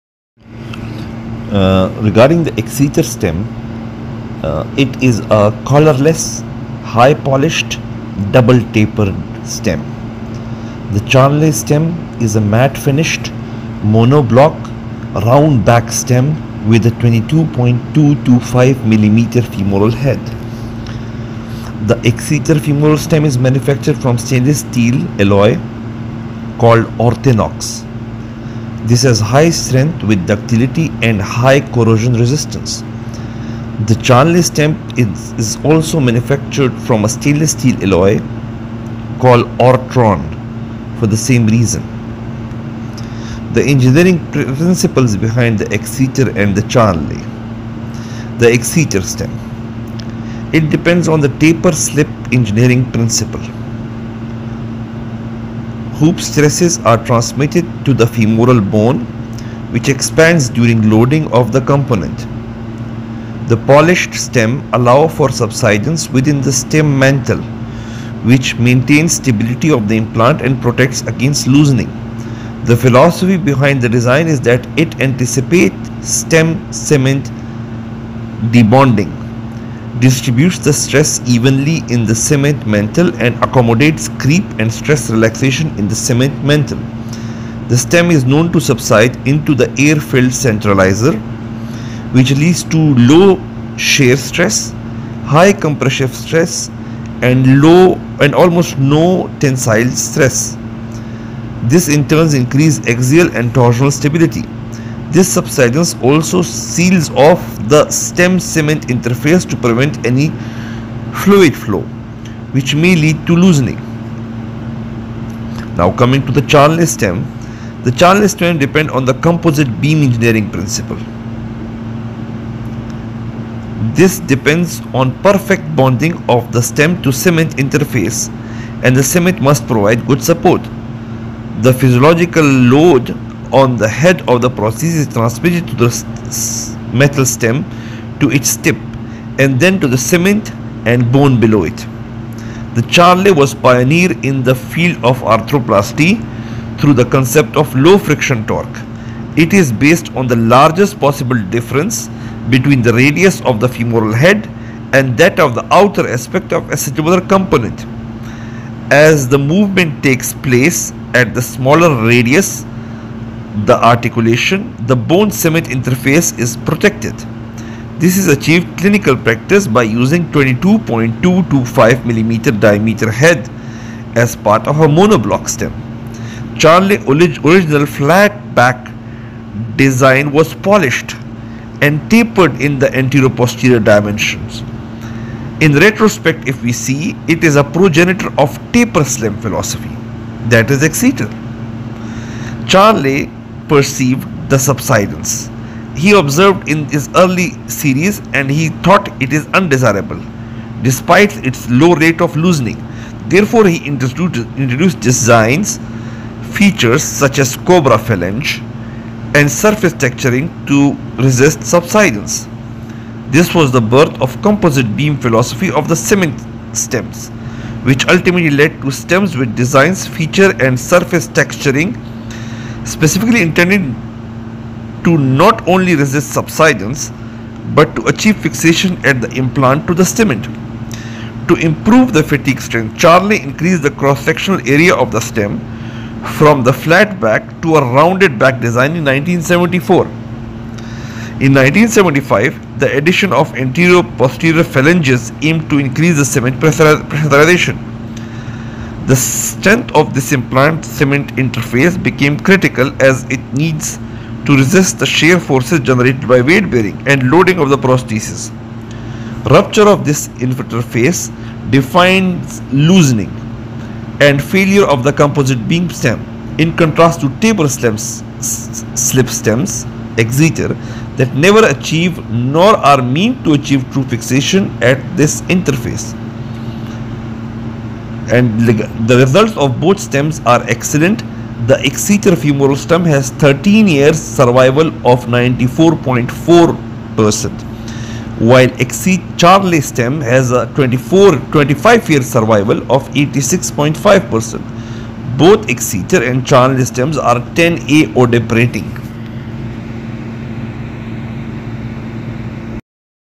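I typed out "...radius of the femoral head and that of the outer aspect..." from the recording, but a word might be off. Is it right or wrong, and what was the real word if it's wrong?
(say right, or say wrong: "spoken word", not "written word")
right.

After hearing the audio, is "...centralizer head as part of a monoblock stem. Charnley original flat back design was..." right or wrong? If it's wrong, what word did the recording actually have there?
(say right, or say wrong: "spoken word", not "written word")
wrong: "diameter", not "centralizer".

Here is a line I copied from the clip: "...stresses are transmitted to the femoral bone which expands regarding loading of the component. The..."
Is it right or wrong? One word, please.
wrong.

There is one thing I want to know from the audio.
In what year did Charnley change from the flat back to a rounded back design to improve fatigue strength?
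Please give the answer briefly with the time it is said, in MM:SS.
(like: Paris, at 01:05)
1974, at 03:59.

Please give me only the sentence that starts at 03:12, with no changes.
Charnley perceive the subsidence he observed in his early series and he thought it is undesirable despite its low rate of loosening.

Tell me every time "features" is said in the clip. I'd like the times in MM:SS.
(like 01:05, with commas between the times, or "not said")
03:26, 03:40.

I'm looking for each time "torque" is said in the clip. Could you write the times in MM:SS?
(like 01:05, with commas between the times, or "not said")
02:28.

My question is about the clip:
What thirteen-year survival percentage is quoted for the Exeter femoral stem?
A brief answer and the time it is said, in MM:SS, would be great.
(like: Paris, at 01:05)
94.4%, at 04:45.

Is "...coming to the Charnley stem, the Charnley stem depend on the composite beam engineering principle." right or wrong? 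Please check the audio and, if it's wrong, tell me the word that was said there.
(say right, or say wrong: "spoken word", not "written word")
right.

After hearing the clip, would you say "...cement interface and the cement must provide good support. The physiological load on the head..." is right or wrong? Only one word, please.
right.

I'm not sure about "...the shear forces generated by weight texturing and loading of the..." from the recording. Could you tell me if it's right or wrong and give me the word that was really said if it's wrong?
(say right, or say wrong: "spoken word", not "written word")
wrong: "bearing", not "texturing".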